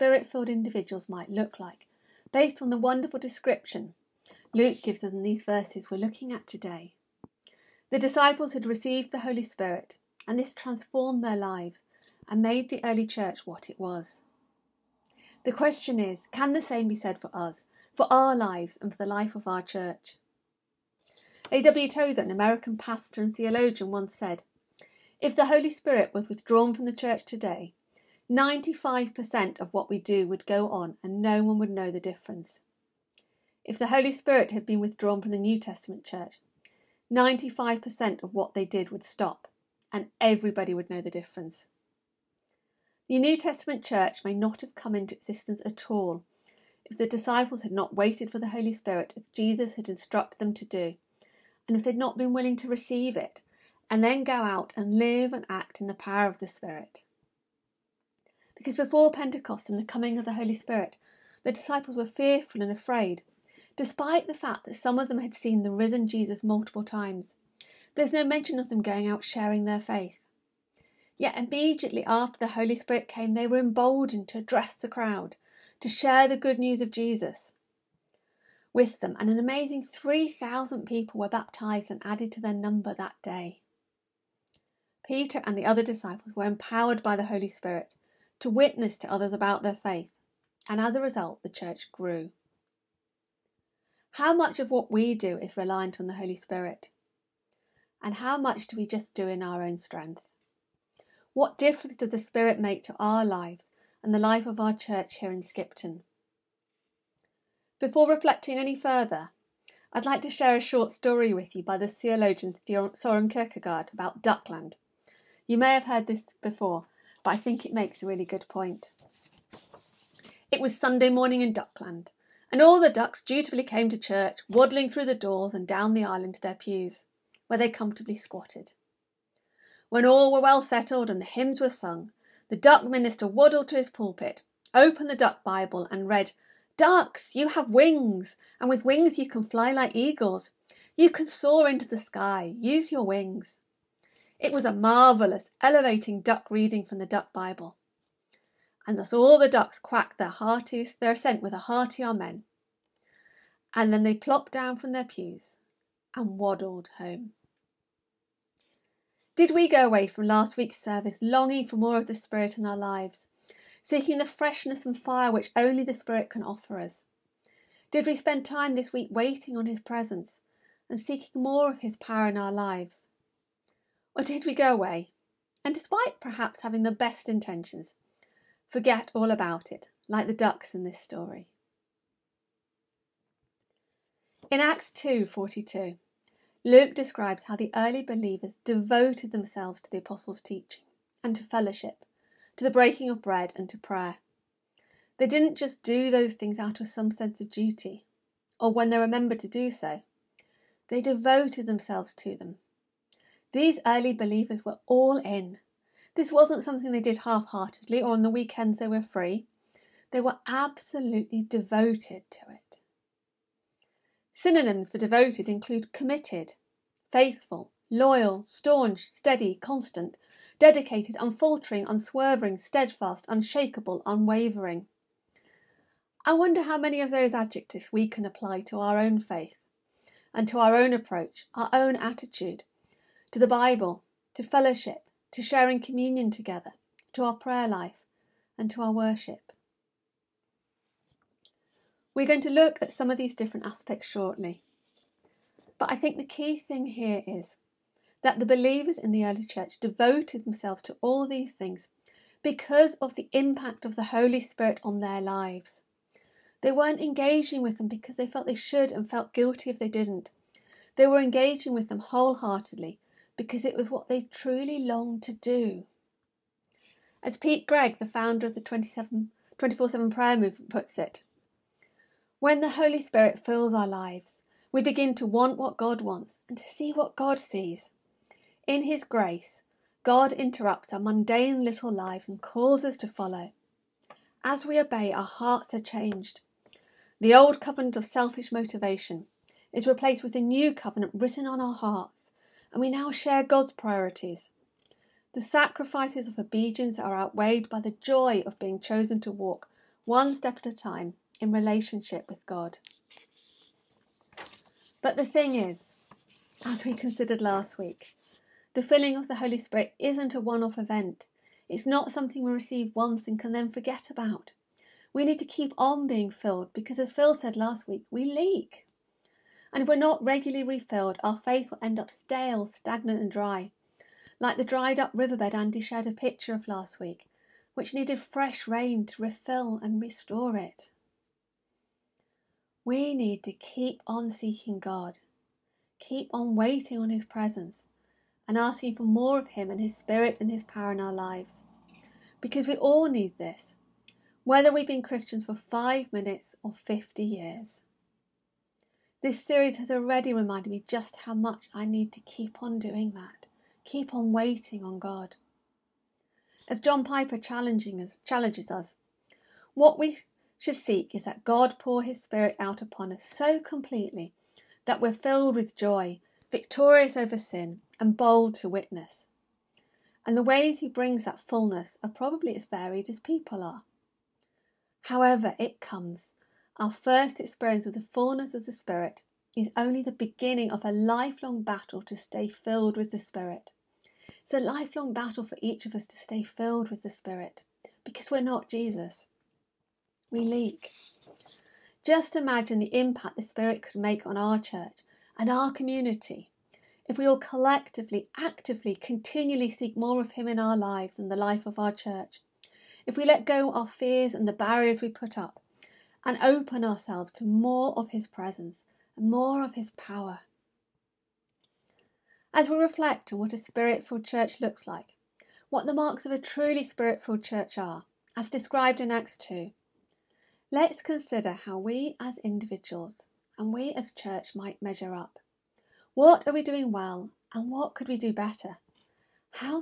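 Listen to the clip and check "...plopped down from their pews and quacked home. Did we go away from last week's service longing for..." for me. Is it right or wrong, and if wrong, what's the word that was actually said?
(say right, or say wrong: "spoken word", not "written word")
wrong: "waddled", not "quacked".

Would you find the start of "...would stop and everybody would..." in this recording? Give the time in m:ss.
0:38.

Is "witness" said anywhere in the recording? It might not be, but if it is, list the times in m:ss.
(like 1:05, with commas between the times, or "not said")
1:28, 6:08.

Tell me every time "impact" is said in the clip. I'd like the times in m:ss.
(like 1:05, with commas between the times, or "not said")
4:13, 6:32.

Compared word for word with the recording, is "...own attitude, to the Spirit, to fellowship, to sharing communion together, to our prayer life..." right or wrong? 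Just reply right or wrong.
wrong.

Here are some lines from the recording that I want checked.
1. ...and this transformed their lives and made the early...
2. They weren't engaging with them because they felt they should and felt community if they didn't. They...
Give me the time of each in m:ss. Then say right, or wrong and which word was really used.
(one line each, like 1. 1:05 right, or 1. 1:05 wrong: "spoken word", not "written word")
1. 0:10 right
2. 4:16 wrong: "guilty", not "community".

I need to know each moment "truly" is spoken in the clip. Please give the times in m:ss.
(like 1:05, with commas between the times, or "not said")
4:24, 6:56.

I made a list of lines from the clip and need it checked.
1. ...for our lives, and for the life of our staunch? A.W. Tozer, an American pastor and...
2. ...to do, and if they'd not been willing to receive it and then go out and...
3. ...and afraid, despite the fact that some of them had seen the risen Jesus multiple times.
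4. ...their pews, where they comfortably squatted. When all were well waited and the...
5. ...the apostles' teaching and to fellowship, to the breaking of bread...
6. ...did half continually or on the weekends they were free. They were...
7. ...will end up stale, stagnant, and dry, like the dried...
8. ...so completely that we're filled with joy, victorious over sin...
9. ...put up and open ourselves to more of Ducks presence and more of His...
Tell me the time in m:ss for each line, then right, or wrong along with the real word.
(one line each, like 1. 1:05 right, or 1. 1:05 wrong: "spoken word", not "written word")
1. 0:17 wrong: "church", not "staunch"
2. 0:50 right
3. 1:02 right
4. 2:06 wrong: "settled", not "waited"
5. 3:09 right
6. 3:27 wrong: "heartedly", not "continually"
7. 5:21 right
8. 6:03 right
9. 6:45 wrong: "His", not "Ducks".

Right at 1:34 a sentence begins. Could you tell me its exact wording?
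How much of what we do is reliant on the Holy Spirit?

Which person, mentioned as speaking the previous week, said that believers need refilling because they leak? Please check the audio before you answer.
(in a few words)
Phil.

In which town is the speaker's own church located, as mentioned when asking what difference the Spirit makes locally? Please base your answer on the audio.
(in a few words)
Skipton.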